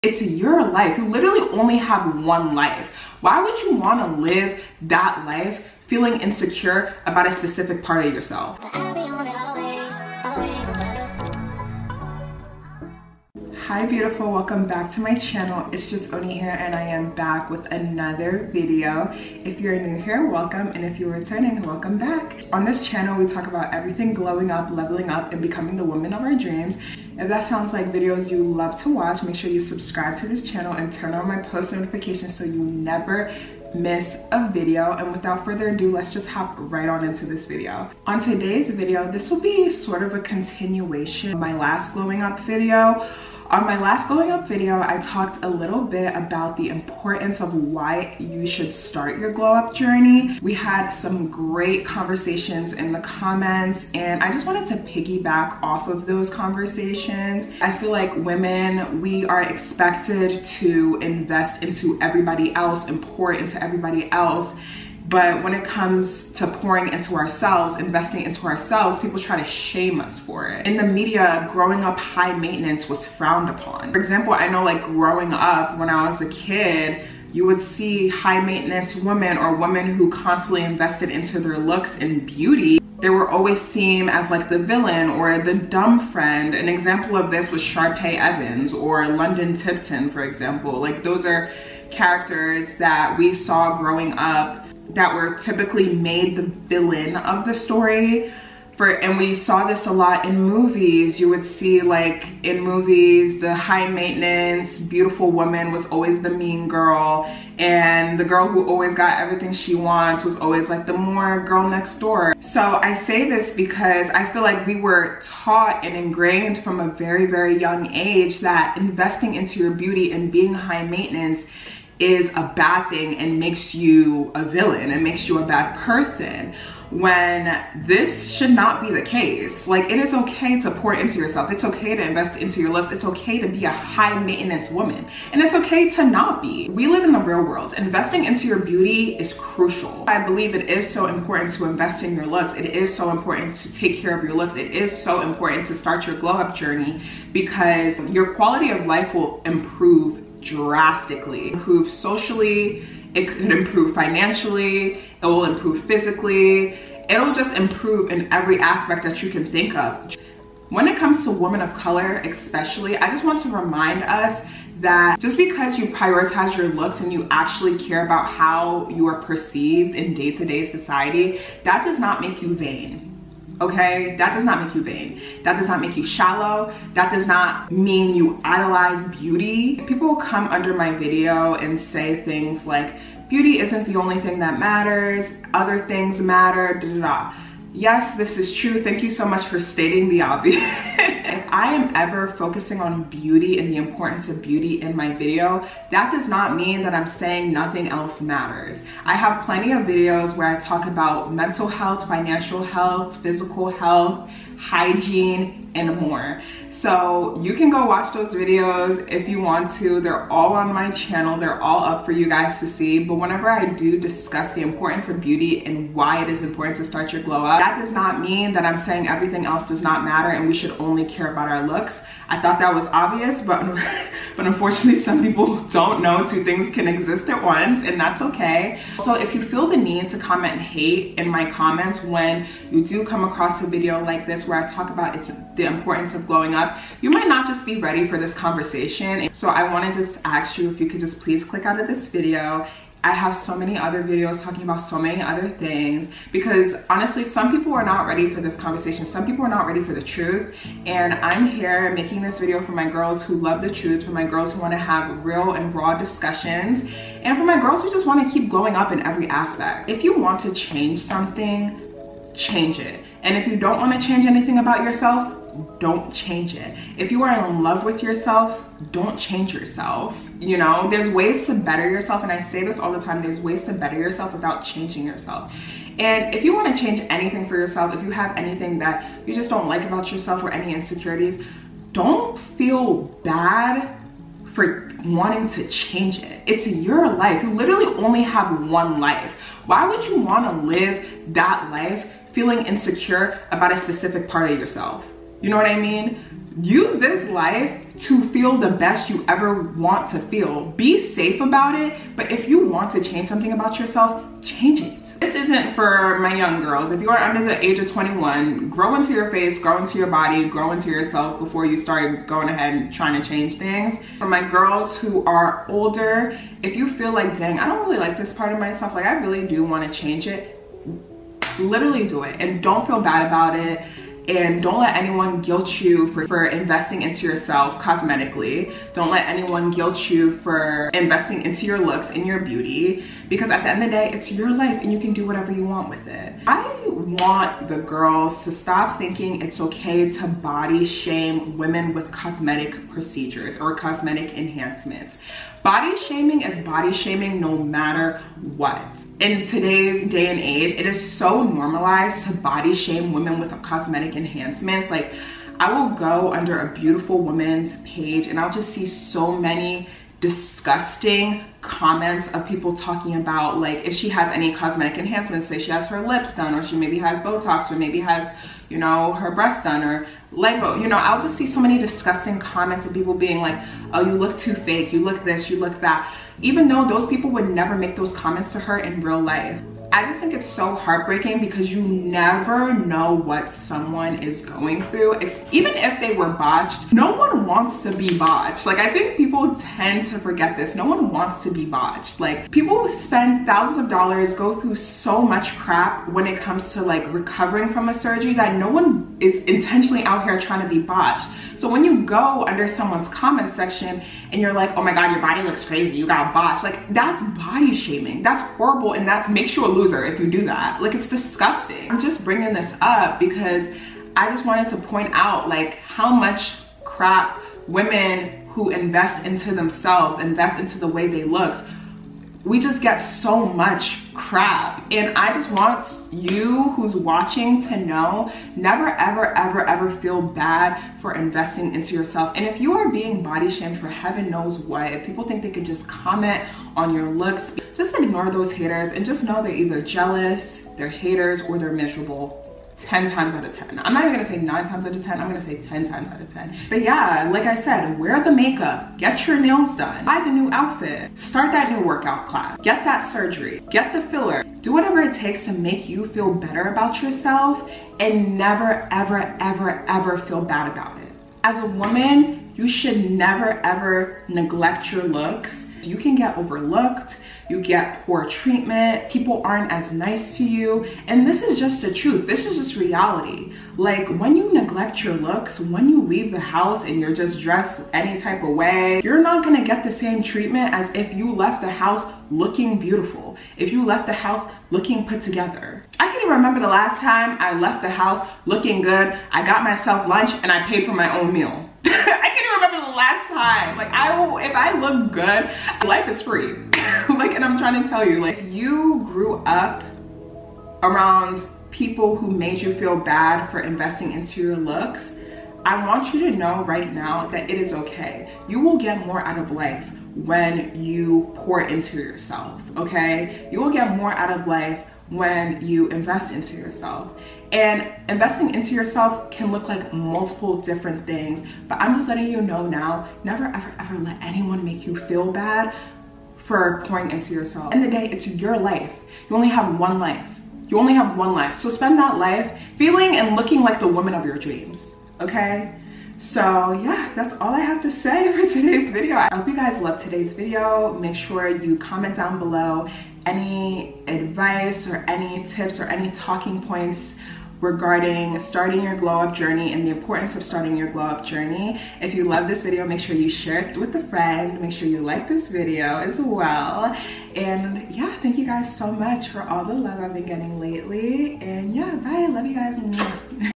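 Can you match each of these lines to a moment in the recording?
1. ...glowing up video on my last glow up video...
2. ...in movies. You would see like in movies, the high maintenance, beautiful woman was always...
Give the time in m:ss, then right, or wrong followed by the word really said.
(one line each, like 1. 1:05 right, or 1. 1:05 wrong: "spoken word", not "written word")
1. 0:41 right
2. 1:40 right.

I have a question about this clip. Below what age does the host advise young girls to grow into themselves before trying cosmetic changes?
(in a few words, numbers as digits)
21.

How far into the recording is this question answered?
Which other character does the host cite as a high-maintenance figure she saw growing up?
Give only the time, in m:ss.
1:29.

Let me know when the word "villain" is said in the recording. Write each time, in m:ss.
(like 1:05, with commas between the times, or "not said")
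1:24, 1:36, 2:04.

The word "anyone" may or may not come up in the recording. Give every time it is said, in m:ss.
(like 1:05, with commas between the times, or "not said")
5:24, 5:29, 8:44.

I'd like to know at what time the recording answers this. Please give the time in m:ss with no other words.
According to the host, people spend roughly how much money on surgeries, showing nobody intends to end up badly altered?
6:33.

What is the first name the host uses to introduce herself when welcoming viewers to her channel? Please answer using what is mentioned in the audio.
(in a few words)
Onyi.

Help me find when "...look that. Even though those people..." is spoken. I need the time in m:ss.
6:15.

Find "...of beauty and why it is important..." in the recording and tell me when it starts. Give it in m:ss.
3:35.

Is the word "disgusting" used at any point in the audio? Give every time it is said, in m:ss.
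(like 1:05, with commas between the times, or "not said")
6:00, 6:11, 6:51.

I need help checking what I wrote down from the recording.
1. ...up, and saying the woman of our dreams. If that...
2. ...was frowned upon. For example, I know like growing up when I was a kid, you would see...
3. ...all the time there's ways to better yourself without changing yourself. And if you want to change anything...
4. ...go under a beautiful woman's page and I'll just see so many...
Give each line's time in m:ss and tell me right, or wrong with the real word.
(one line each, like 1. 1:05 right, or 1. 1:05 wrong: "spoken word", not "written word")
1. 0:25 wrong: "becoming", not "saying"
2. 1:12 right
3. 4:32 right
4. 5:55 right.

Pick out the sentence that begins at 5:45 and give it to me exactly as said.
Body shaming is body shaming no matter what.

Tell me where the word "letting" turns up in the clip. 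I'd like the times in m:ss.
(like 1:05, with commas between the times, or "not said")
8:42.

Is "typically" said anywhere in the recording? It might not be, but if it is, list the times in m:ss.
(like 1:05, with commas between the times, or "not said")
1:35.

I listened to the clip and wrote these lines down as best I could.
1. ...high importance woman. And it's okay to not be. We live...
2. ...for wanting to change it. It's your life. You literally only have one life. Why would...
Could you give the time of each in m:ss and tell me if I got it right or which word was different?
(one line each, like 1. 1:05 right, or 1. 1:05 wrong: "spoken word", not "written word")
1. 2:13 wrong: "maintenance", not "importance"
2. 4:44 right.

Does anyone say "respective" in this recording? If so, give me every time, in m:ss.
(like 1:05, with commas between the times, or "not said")
not said.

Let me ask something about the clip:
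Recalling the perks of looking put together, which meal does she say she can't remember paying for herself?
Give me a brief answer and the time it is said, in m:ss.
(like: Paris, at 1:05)
lunch, at 8:10.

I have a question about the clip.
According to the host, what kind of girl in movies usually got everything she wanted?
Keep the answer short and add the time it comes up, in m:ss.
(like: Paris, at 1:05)
girl next door, at 1:51.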